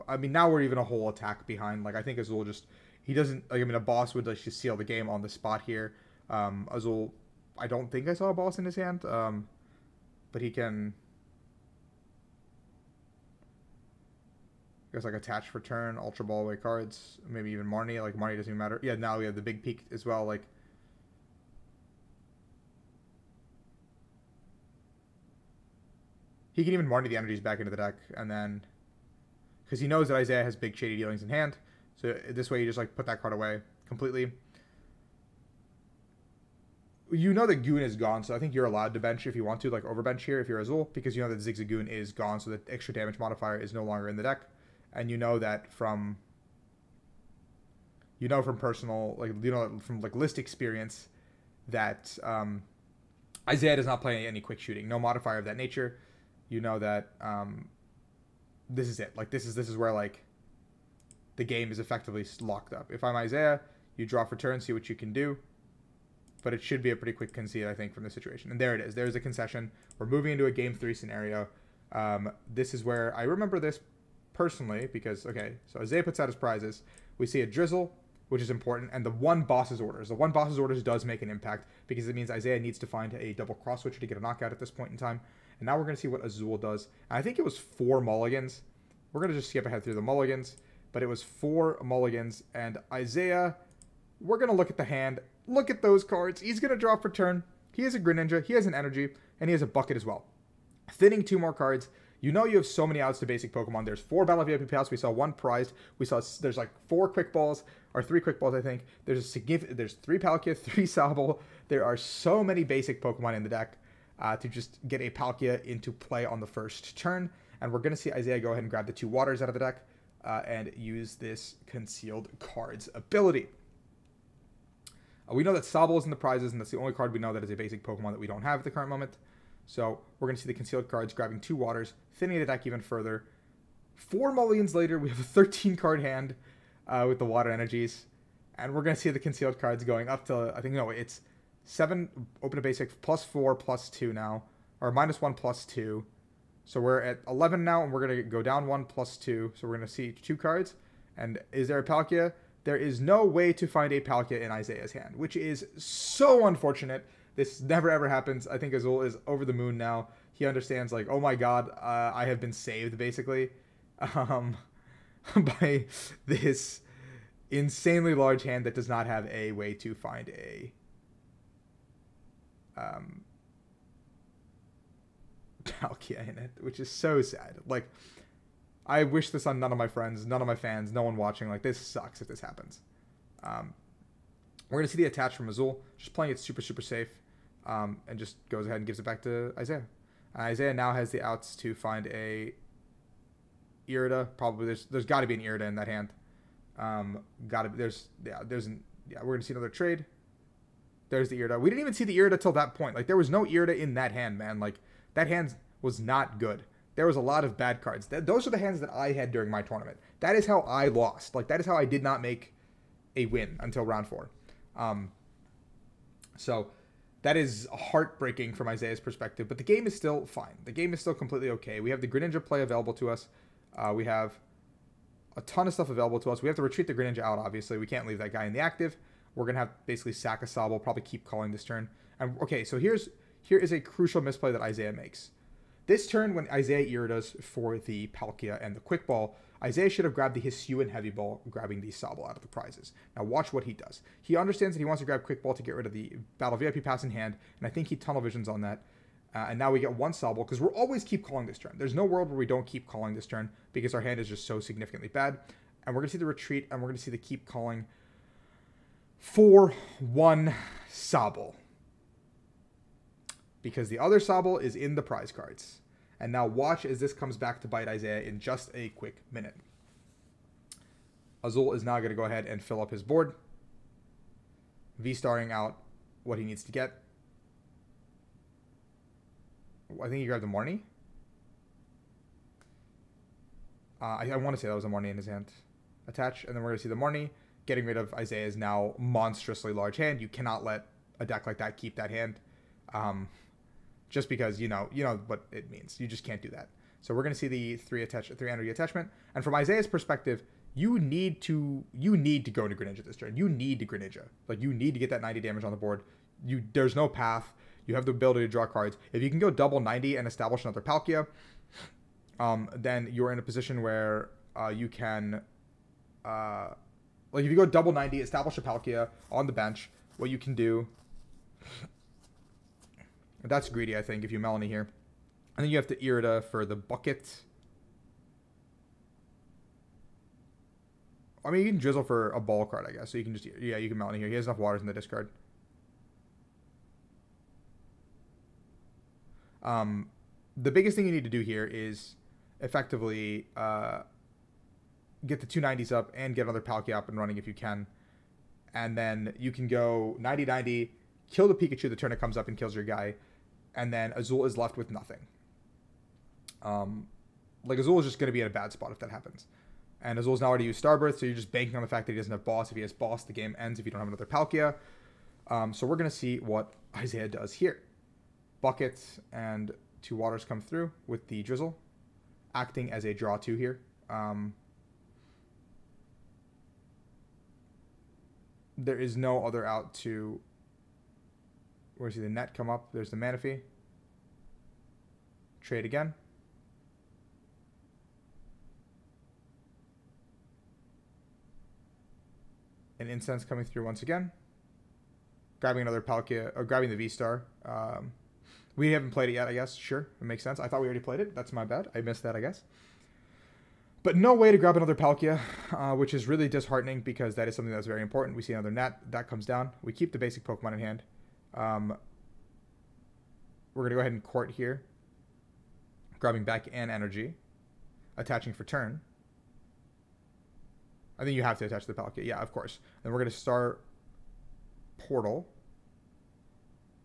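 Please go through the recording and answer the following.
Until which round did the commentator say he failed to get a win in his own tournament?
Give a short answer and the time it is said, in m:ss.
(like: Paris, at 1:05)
round four, at 3:33.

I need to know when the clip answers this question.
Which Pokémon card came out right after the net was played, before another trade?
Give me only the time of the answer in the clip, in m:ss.
6:23.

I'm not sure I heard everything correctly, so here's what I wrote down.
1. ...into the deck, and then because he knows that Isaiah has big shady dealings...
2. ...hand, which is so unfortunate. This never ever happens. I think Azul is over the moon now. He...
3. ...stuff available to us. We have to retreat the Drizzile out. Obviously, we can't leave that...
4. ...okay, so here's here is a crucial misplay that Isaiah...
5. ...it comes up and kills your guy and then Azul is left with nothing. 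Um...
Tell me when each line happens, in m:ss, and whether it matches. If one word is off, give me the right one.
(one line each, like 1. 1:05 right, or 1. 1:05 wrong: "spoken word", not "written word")
1. 0:27 right
2. 2:34 right
3. 3:45 wrong: "Greninja", not "Drizzile"
4. 3:52 right
5. 5:52 right.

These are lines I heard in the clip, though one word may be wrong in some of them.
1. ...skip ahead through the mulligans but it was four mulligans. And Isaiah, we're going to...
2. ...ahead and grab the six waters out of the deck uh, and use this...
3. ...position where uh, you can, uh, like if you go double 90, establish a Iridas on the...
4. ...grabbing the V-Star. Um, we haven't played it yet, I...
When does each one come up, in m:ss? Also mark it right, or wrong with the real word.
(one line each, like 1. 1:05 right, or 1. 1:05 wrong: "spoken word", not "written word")
1. 1:29 right
2. 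1:58 wrong: "two", not "six"
3. 5:13 wrong: "Palkia", not "Iridas"
4. 6:36 right.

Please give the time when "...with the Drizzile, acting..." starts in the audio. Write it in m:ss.
6:11.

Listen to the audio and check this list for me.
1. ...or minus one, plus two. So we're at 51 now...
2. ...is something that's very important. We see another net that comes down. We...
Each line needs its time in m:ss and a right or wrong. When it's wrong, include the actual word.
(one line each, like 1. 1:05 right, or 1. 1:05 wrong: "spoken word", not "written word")
1. 2:24 wrong: "11", not "51"
2. 6:47 right.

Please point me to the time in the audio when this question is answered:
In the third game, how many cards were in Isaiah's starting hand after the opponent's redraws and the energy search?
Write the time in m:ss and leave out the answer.
2:15.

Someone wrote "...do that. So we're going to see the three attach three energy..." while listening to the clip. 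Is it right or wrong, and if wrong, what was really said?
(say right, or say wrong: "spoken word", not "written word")
right.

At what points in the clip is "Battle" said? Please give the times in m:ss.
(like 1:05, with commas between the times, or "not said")
1:44, 4:06.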